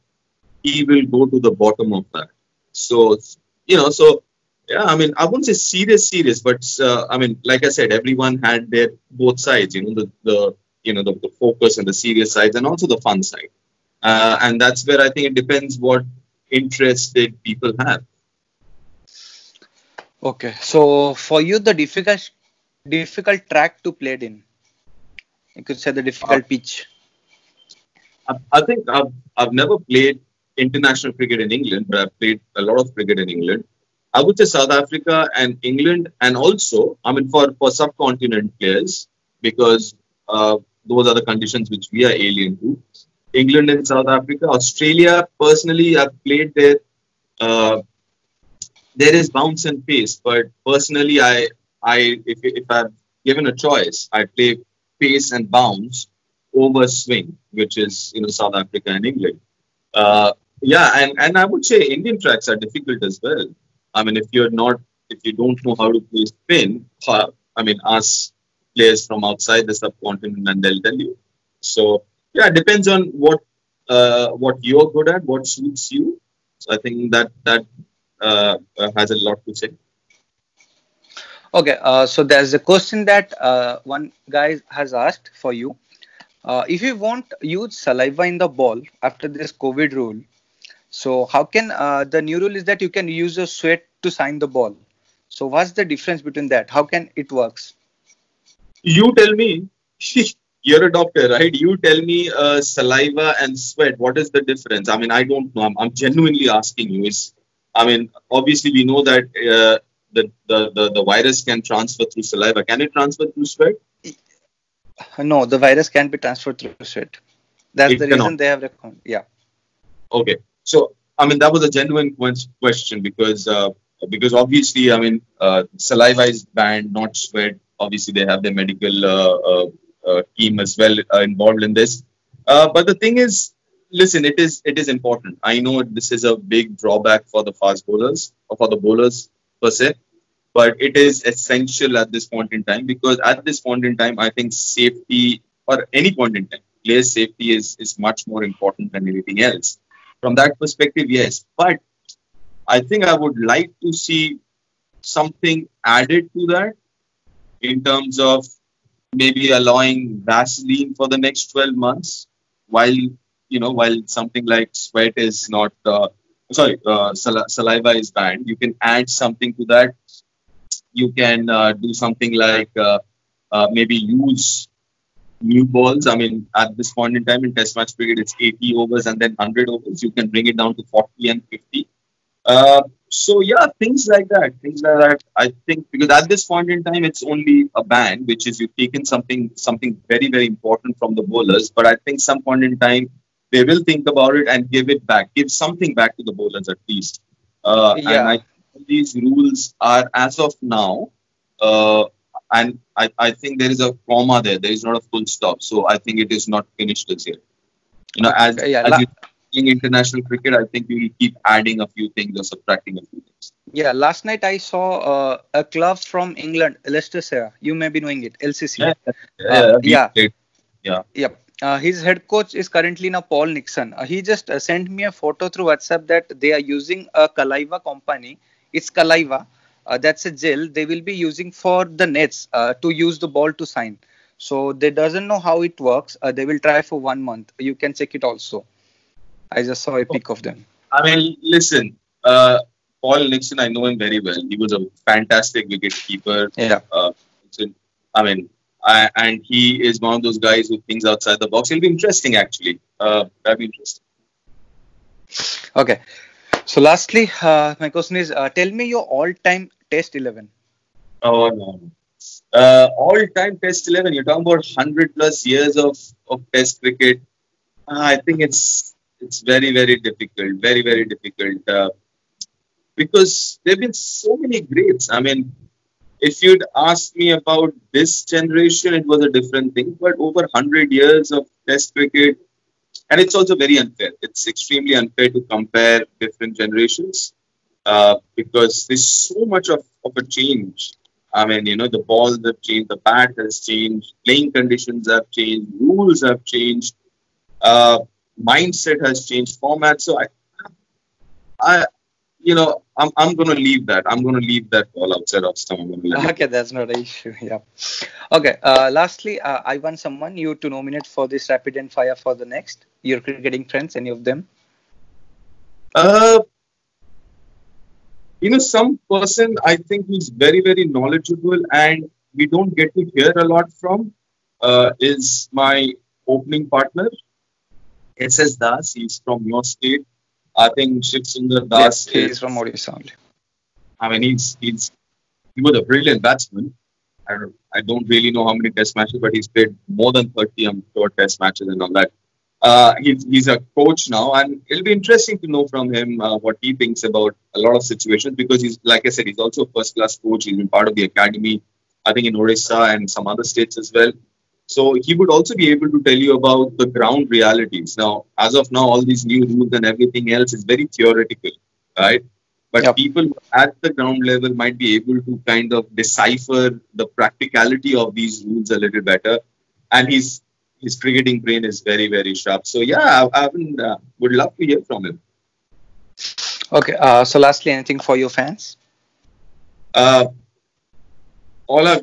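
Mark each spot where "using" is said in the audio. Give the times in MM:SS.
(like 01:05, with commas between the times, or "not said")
03:46, 03:51.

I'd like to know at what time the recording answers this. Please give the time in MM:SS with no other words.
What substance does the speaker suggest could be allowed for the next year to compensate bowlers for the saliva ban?
02:40.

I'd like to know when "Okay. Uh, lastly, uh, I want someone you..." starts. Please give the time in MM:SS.
05:08.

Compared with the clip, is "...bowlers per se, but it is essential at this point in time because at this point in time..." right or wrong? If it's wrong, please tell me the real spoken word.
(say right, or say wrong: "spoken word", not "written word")
right.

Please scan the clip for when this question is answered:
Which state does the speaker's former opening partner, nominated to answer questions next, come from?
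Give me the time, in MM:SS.
05:32.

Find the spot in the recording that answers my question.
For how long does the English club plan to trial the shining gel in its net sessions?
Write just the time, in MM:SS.
03:57.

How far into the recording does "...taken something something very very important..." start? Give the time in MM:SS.
03:08.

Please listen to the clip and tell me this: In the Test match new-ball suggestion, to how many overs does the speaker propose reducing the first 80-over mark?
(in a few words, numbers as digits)
40.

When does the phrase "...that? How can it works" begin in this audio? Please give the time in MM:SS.
01:36.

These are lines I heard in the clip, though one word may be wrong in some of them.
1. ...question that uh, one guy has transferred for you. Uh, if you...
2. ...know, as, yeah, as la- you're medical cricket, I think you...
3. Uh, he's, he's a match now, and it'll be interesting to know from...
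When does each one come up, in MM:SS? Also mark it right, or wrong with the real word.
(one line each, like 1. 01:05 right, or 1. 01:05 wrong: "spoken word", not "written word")
1. 01:22 wrong: "asked", not "transferred"
2. 03:28 wrong: "international", not "medical"
3. 05:42 wrong: "coach", not "match".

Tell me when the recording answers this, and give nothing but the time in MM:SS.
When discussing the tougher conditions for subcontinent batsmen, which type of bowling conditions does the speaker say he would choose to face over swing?
00:55.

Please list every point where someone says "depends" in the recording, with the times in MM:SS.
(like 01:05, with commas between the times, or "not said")
00:15, 01:12.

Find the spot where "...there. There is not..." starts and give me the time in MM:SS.
03:24.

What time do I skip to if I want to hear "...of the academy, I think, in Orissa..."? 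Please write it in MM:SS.
05:50.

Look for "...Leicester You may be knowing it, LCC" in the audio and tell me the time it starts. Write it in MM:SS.
03:36.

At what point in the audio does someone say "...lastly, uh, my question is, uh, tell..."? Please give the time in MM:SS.
04:16.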